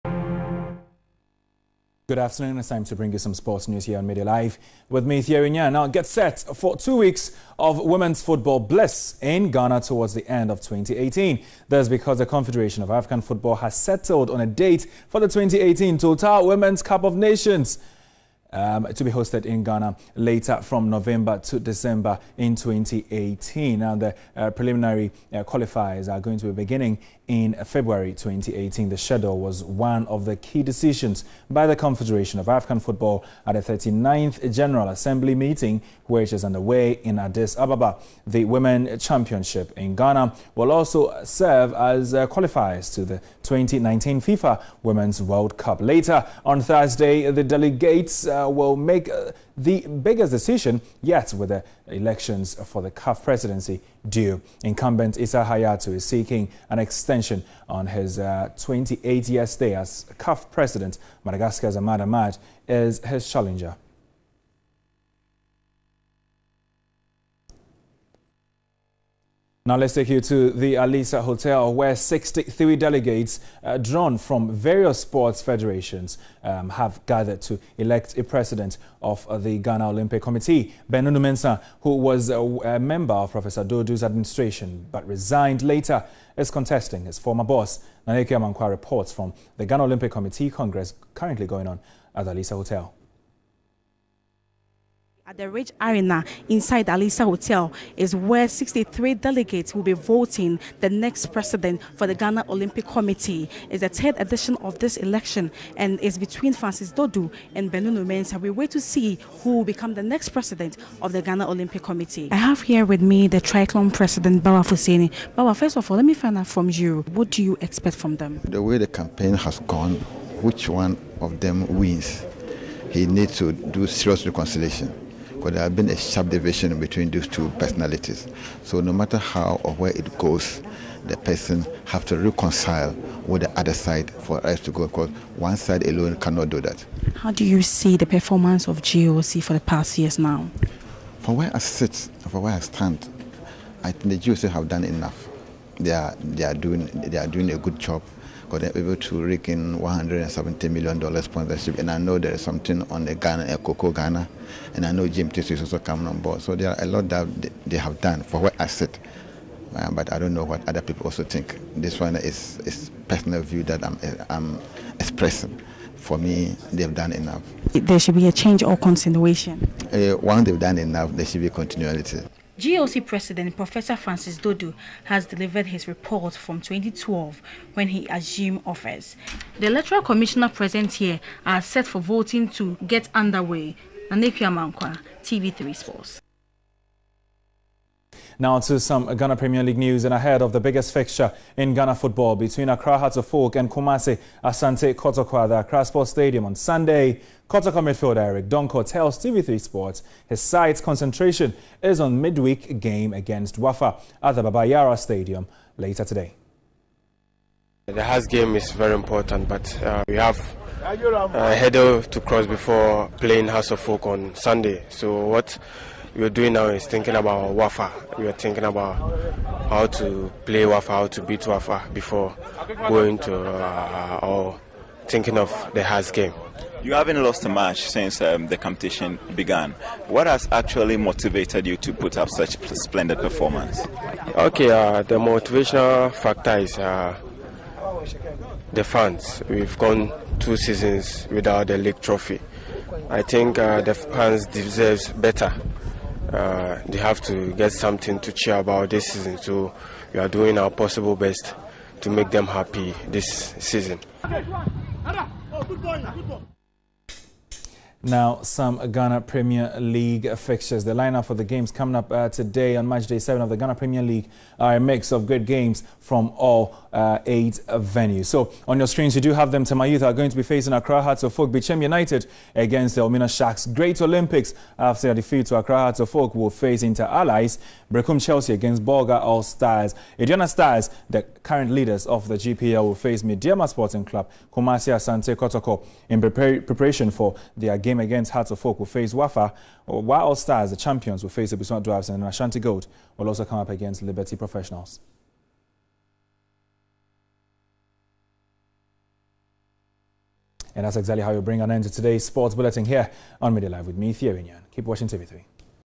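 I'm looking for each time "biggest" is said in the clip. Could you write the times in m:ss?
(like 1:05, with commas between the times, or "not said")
0:49, 3:10.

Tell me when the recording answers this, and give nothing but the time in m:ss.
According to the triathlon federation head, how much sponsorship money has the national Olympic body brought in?
2:29.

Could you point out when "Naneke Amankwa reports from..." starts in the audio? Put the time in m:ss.
1:28.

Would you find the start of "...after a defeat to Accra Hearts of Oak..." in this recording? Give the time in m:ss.
4:34.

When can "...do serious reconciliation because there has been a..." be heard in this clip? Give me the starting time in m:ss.
2:03.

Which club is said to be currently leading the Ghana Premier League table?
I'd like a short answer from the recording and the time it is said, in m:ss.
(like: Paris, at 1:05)
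Aduana Stars, at 4:40.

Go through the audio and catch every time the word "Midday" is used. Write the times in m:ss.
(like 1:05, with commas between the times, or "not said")
0:04, 5:03.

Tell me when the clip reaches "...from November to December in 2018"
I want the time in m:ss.
0:20.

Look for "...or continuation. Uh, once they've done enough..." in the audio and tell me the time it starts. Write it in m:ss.
2:48.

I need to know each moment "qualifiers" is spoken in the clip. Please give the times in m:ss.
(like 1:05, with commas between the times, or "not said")
0:25, 0:42.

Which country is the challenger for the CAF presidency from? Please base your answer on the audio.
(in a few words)
Madagascar.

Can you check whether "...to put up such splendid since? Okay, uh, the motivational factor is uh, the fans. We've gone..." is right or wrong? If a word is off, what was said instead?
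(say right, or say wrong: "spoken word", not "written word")
wrong: "performance", not "since".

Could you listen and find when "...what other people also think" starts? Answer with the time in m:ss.
2:40.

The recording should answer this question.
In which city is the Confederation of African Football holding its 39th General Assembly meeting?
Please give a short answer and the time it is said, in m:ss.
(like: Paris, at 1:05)
Addis Ababa, at 0:37.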